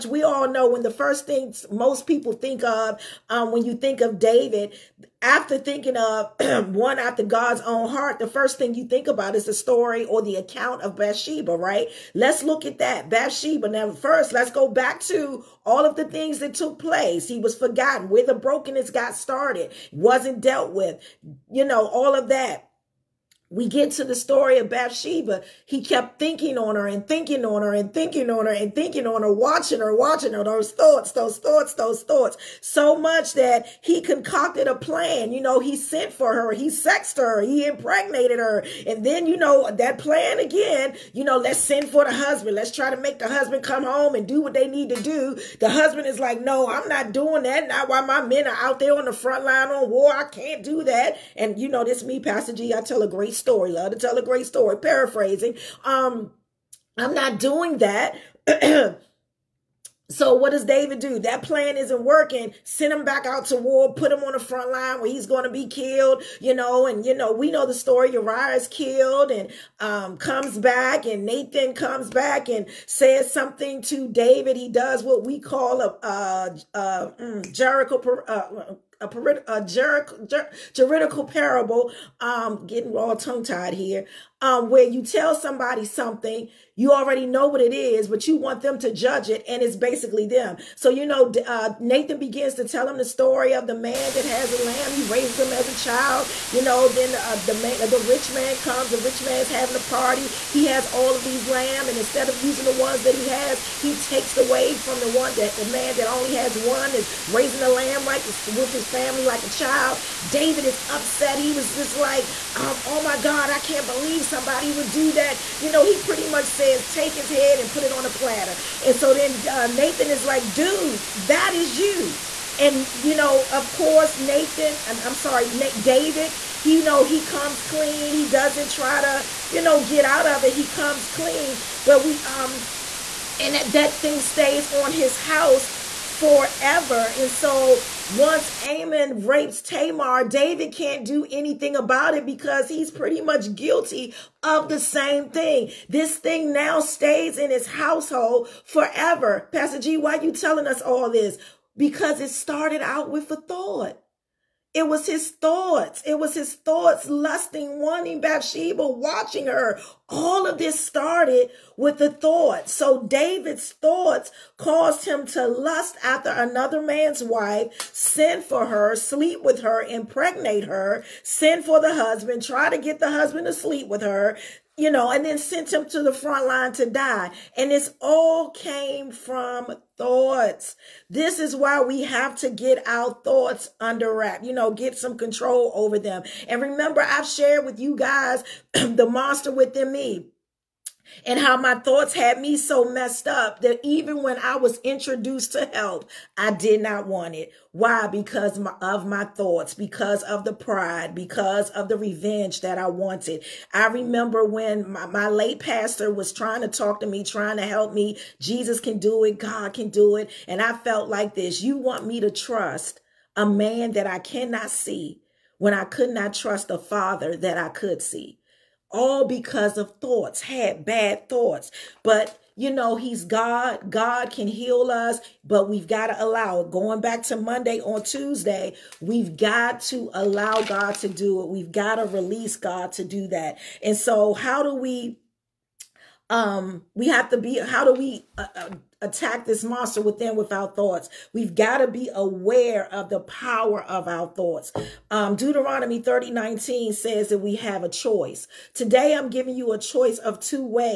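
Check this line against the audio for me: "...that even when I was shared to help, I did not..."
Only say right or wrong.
wrong.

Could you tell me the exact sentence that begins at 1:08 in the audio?
Uriah is killed and um, comes back and Nathan comes back and says something to David.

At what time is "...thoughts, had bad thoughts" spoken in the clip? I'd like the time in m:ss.
3:39.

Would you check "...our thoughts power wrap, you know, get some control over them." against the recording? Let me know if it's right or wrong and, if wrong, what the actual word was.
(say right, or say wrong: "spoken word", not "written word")
wrong: "under", not "power".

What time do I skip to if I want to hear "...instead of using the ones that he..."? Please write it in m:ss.
1:41.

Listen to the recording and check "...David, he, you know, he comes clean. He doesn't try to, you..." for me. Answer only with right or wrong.
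right.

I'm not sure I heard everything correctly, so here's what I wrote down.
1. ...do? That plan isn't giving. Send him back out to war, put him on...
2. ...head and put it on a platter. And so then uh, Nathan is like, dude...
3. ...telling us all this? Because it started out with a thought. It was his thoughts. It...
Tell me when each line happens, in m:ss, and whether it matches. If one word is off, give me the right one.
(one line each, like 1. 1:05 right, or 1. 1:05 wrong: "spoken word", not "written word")
1. 1:00 wrong: "working", not "giving"
2. 1:57 right
3. 2:30 right.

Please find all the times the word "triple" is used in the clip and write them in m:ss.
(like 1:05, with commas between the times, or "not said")
not said.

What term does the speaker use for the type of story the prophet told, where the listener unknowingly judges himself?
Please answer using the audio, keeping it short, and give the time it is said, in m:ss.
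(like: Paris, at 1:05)
juridical parable, at 1:20.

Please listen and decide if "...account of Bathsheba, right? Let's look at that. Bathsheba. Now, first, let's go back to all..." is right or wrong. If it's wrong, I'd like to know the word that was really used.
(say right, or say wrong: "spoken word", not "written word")
right.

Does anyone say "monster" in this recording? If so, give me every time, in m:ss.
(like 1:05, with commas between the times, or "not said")
3:09, 3:59.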